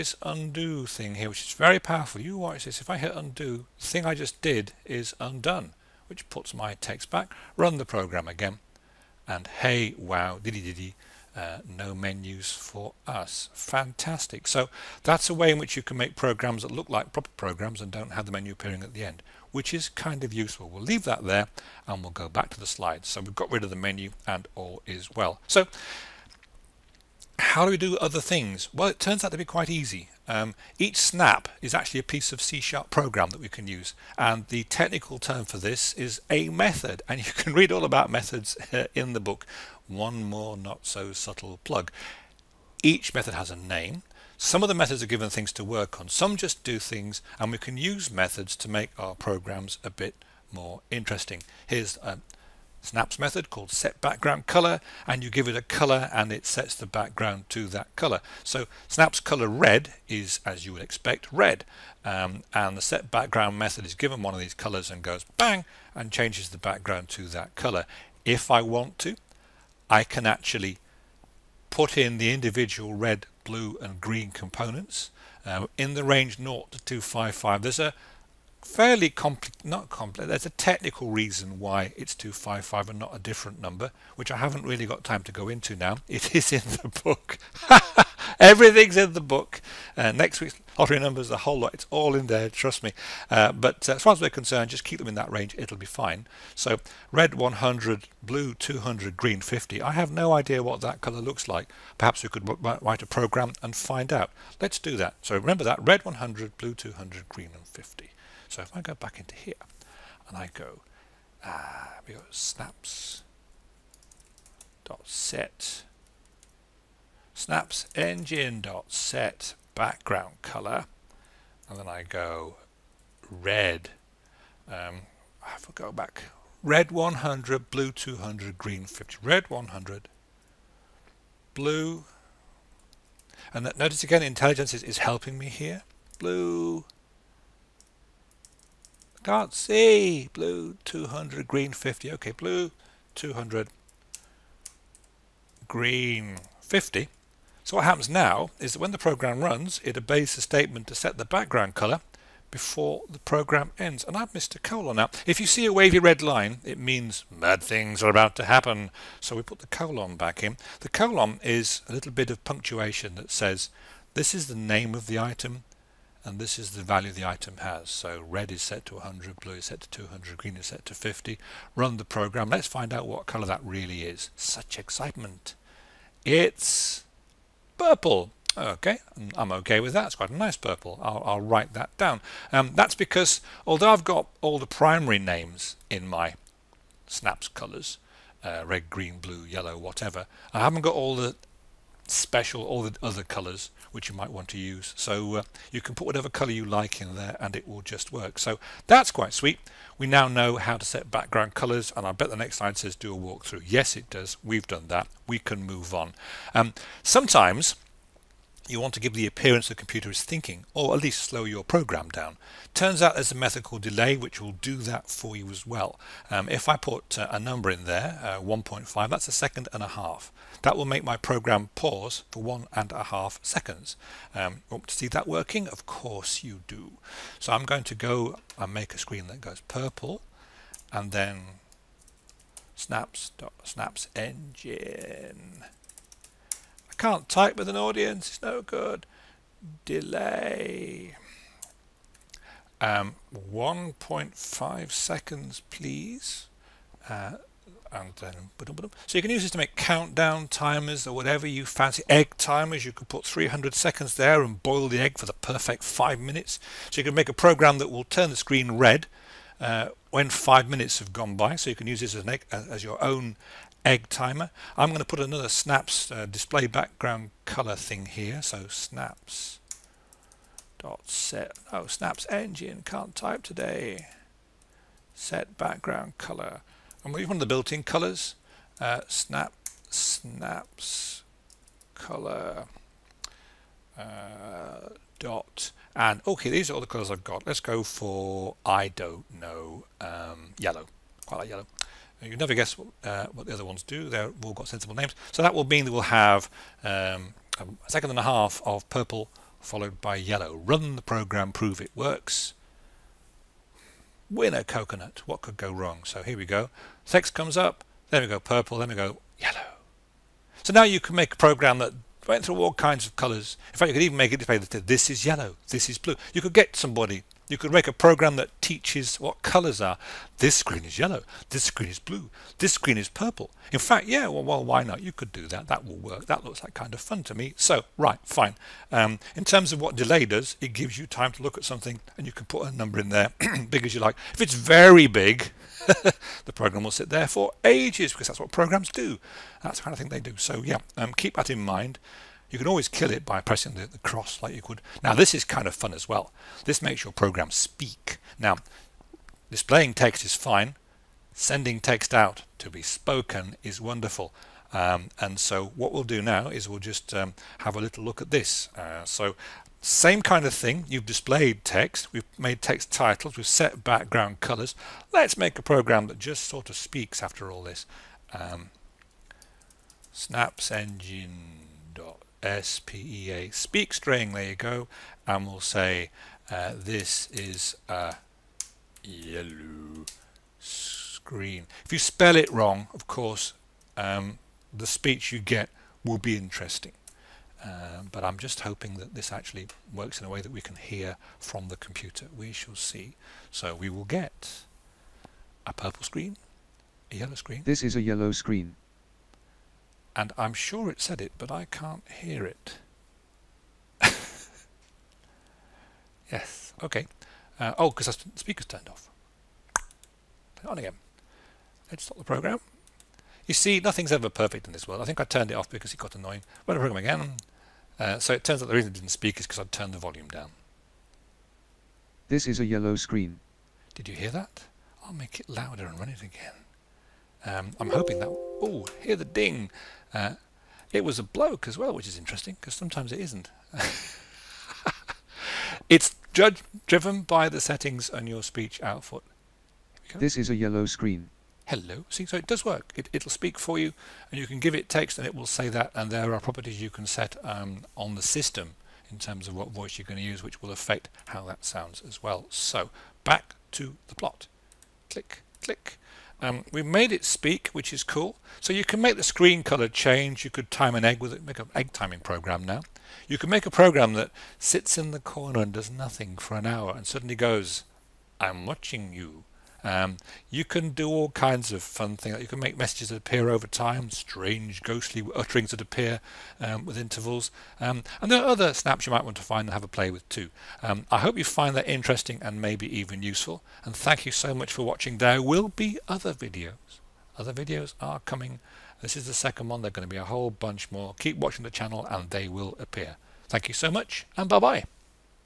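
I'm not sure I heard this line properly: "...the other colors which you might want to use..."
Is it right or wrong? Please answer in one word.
right.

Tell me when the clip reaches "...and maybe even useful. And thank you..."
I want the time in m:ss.
8:02.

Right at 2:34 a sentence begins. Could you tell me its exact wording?
And I've missed a colon now.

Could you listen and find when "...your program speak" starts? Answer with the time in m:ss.
5:47.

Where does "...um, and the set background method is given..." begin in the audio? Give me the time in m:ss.
1:02.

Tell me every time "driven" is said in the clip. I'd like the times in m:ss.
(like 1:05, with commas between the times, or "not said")
7:16.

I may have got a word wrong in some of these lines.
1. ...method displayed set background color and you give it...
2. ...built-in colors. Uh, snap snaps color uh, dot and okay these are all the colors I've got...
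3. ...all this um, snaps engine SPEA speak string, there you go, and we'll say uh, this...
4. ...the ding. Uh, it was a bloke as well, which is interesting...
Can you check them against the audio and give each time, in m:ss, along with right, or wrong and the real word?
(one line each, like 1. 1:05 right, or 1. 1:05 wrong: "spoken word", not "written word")
1. 0:53 wrong: "called", not "displayed"
2. 4:37 right
3. 6:07 right
4. 7:09 right.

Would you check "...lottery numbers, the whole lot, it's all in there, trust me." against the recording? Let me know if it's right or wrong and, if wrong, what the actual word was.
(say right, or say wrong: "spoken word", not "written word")
right.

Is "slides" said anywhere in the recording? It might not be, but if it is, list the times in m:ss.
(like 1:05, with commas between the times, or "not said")
0:22, 3:22.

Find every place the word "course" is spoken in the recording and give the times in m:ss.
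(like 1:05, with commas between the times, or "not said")
3:45, 6:23.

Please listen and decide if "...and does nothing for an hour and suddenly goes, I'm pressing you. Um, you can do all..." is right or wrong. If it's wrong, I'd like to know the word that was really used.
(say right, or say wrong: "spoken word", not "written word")
wrong: "watching", not "pressing".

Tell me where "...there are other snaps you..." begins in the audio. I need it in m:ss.
7:58.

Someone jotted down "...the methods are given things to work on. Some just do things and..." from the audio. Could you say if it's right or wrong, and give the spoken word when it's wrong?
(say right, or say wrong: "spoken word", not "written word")
right.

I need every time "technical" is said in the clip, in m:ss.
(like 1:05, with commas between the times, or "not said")
0:34, 1:20.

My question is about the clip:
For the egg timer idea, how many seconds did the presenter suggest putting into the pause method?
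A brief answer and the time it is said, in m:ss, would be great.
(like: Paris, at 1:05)
300, at 4:13.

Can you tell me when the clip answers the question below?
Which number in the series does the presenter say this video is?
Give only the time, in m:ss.
8:09.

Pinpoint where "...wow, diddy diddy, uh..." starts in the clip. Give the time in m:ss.
0:09.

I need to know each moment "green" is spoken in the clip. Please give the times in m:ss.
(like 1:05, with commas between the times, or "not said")
1:13, 1:39, 1:47, 2:08, 2:21, 2:25, 2:50, 3:08.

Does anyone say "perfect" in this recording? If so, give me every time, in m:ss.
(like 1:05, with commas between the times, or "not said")
4:15, 6:54.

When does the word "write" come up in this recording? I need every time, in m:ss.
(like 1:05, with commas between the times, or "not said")
1:42, 3:01.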